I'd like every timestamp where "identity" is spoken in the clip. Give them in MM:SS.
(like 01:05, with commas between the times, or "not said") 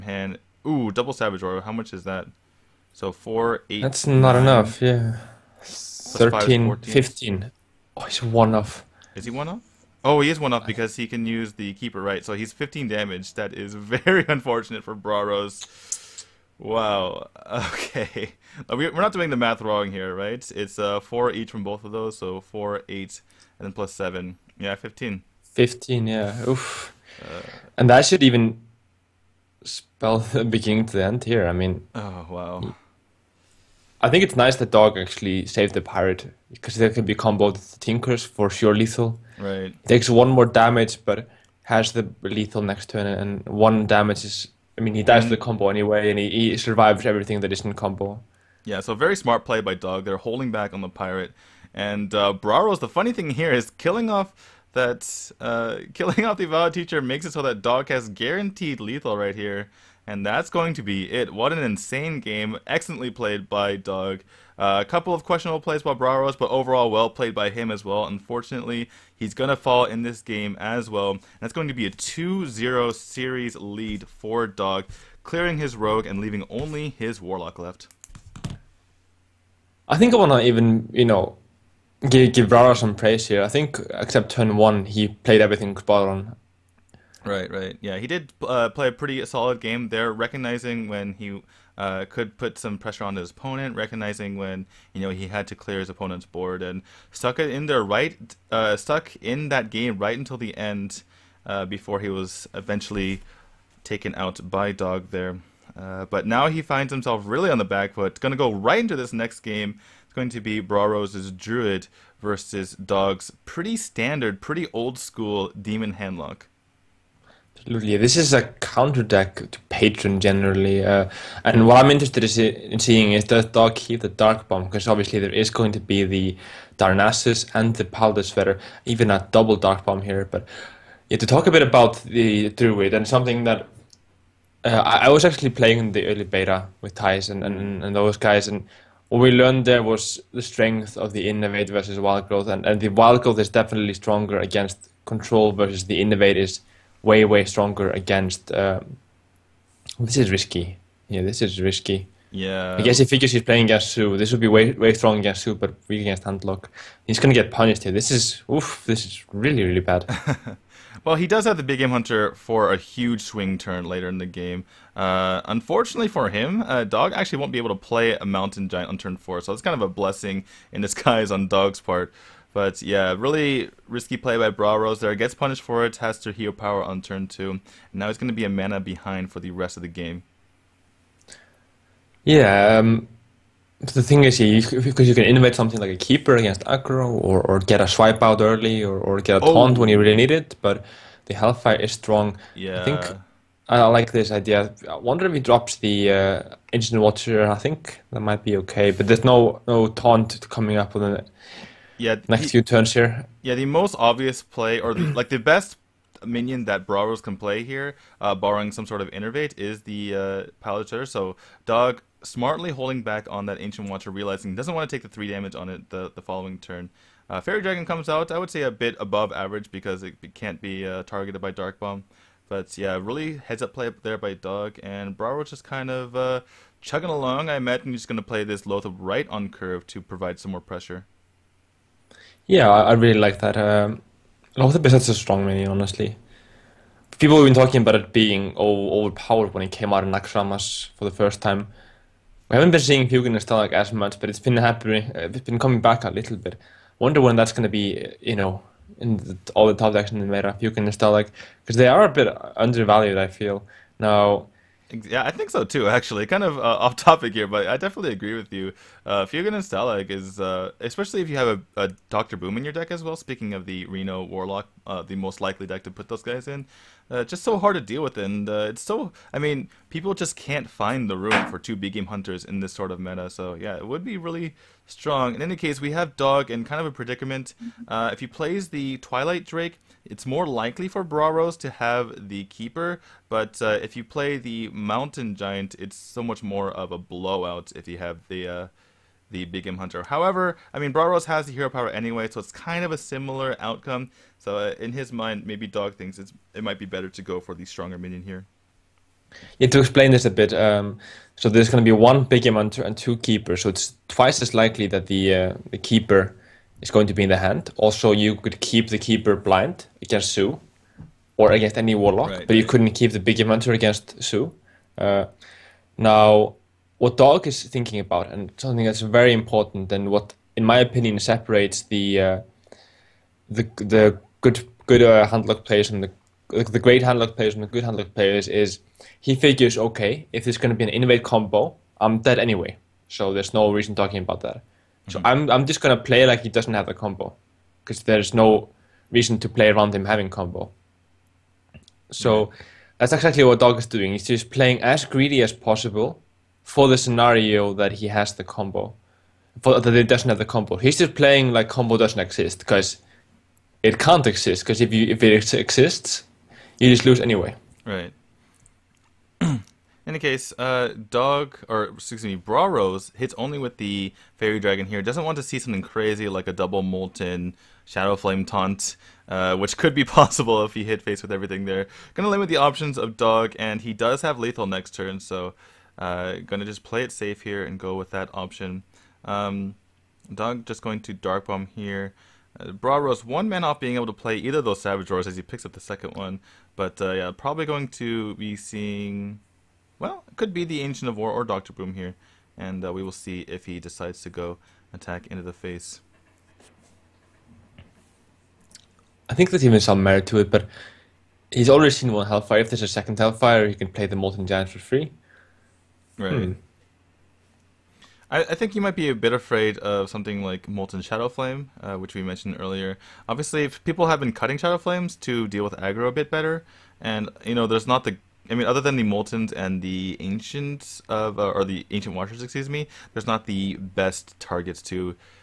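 not said.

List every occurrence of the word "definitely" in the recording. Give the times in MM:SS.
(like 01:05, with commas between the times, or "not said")
02:23, 04:17.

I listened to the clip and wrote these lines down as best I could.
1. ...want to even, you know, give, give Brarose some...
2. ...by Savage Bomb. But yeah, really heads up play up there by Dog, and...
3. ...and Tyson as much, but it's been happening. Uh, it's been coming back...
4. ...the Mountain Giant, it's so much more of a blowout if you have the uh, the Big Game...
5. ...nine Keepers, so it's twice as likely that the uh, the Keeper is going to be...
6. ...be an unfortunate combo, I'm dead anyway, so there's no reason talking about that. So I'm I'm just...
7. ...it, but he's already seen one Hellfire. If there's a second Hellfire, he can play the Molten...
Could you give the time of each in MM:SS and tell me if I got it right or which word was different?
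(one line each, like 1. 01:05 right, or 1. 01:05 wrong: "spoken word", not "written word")
1. 01:20 right
2. 03:41 wrong: "Dark", not "Savage"
3. 04:03 wrong: "Stalagg", not "Tyson"
4. 04:44 right
5. 05:02 wrong: "two", not "nine"
6. 05:30 wrong: "innervate", not "unfortunate"
7. 06:40 right.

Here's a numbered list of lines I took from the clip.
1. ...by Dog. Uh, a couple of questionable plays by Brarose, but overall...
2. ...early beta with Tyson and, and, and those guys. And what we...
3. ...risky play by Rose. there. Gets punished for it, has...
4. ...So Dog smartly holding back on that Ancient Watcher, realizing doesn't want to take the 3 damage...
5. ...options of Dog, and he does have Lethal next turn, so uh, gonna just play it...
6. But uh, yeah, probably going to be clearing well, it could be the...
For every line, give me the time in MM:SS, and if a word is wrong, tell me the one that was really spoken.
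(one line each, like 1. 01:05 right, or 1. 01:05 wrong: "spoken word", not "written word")
1. 01:03 right
2. 02:16 right
3. 02:53 right
4. 03:31 right
5. 06:12 right
6. 06:26 wrong: "seeing", not "clearing".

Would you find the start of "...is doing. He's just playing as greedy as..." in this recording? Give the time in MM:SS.
05:43.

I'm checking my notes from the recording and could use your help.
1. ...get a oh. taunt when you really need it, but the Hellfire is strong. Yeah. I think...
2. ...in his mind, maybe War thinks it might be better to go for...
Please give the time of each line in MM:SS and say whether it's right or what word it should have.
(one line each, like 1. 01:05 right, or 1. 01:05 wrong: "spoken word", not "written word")
1. 03:09 right
2. 04:54 wrong: "Dog", not "War".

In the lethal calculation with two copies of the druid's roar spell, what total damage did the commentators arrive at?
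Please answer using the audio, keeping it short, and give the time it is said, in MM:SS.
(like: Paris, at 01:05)
15, at 00:12.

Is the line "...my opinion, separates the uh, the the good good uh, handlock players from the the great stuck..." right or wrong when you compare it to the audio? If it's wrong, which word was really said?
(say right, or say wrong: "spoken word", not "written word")
wrong: "handlock", not "stuck".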